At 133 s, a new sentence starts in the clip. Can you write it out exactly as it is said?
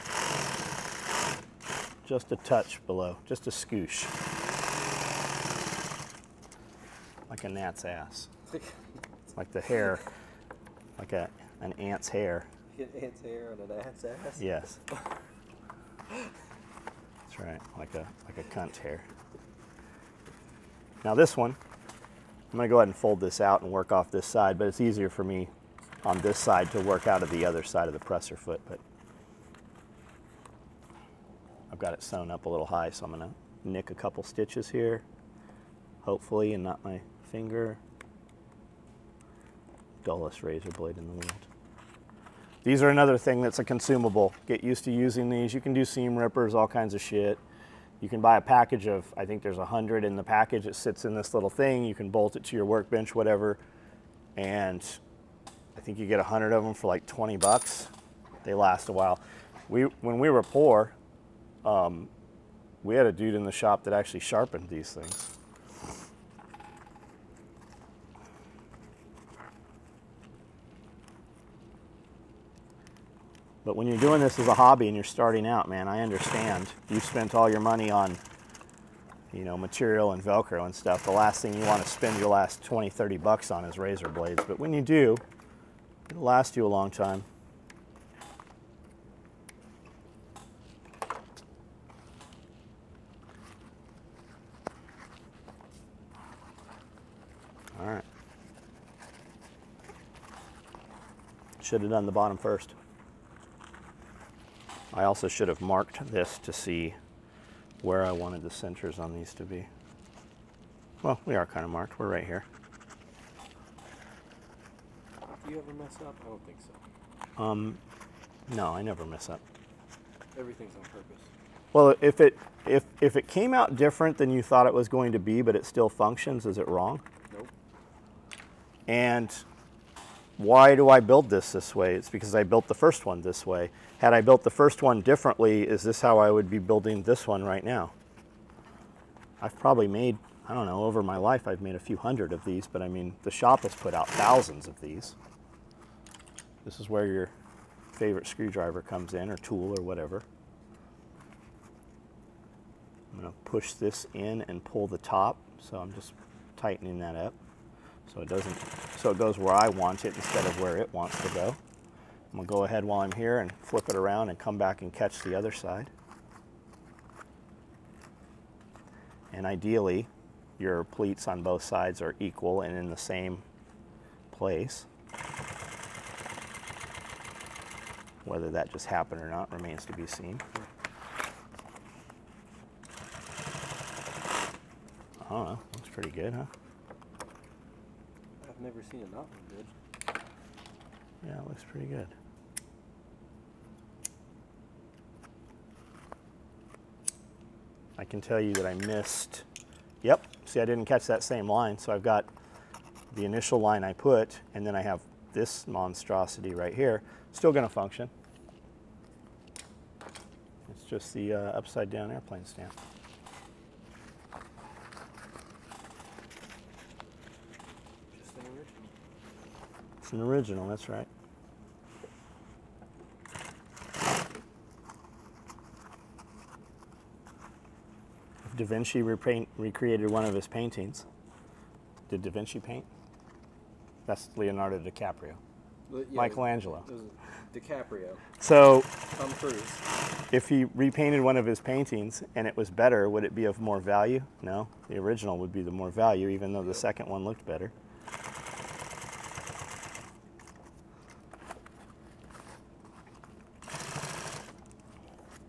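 Had I built the first one differently, is this how I would be building this one right now?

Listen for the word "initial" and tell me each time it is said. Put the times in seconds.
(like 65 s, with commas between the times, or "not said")
203 s.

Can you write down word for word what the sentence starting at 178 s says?
Whether that just happened or not remains to be seen.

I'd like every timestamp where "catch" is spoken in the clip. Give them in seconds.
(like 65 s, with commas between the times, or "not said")
164 s, 200 s.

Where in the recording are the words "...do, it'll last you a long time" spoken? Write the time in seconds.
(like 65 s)
84 s.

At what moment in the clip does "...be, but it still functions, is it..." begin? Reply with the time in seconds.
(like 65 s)
125 s.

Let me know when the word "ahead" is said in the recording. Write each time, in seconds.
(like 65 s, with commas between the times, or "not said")
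22 s, 162 s.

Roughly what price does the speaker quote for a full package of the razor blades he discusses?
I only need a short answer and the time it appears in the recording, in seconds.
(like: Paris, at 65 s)
20 bucks, at 56 s.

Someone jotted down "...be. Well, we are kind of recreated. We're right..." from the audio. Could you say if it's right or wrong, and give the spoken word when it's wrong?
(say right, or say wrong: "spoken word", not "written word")
wrong: "marked", not "recreated".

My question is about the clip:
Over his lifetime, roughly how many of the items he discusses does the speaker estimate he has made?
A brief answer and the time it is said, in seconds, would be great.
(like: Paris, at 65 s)
a few hundred, at 141 s.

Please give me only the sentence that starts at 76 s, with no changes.
You spent all your money on, you know, material and Velcro and stuff.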